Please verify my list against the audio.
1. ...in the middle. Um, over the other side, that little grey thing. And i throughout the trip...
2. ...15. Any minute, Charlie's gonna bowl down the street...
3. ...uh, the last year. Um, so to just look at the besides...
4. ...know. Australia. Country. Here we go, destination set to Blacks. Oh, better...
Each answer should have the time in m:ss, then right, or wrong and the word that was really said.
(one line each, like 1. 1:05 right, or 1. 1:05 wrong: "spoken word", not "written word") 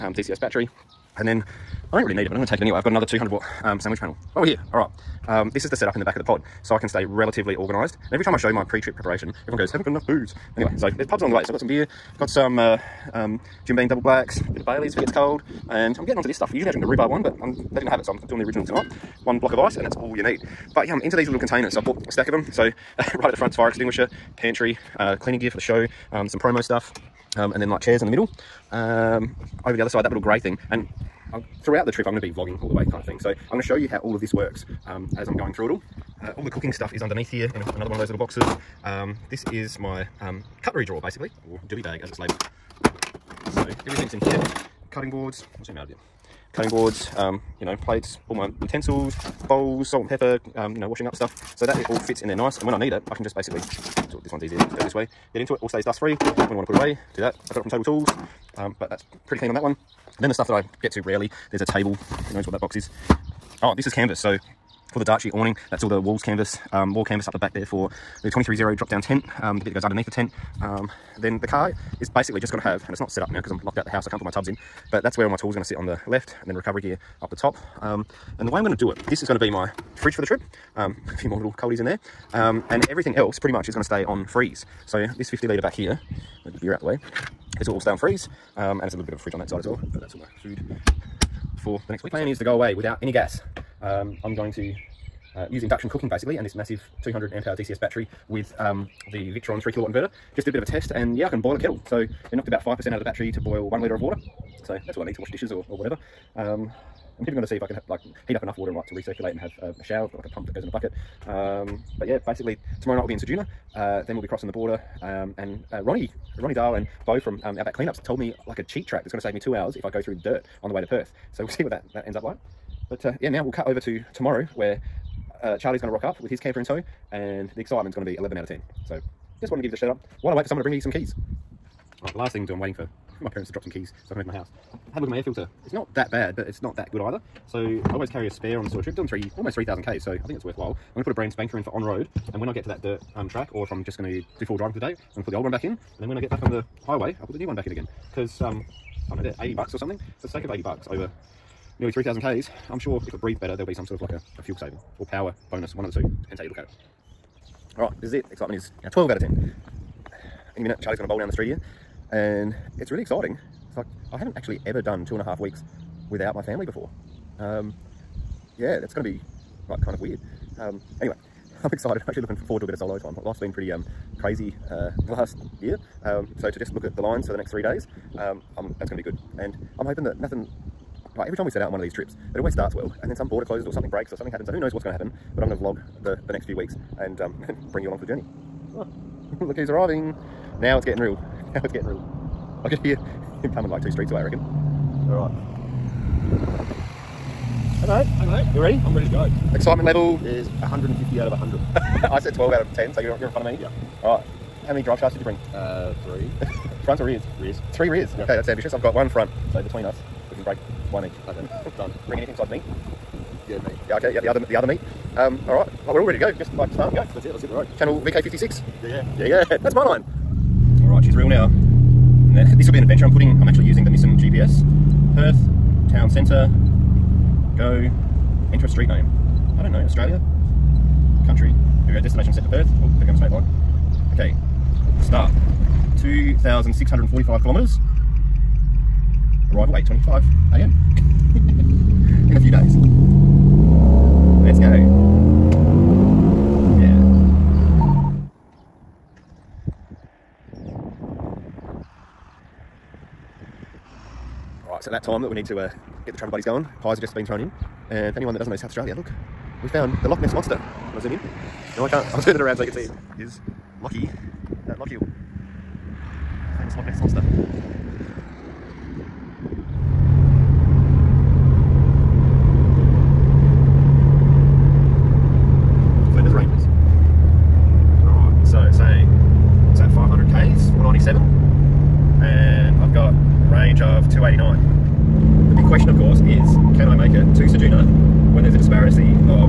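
1. 0:28 right
2. 2:39 wrong: "10", not "15"
3. 2:54 wrong: "lines", not "besides"
4. 3:49 wrong: "Perth", not "Blacks".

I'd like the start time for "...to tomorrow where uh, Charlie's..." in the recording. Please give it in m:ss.
2:03.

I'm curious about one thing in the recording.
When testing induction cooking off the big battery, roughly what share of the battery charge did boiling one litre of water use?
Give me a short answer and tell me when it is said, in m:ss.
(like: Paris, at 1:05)
5%, at 1:42.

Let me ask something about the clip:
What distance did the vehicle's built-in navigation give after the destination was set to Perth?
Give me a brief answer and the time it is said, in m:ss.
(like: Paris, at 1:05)
2,645 kilometres, at 3:56.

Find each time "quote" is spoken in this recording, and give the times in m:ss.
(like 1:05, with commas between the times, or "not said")
not said.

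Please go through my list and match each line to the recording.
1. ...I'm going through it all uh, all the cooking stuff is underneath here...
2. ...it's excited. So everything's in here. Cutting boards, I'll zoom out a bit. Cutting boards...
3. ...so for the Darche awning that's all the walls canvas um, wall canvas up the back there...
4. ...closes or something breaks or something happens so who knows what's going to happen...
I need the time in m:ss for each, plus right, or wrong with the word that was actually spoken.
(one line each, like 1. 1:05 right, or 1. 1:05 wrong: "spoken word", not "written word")
1. 0:35 right
2. 0:42 wrong: "labelled", not "excited"
3. 1:04 right
4. 3:03 right.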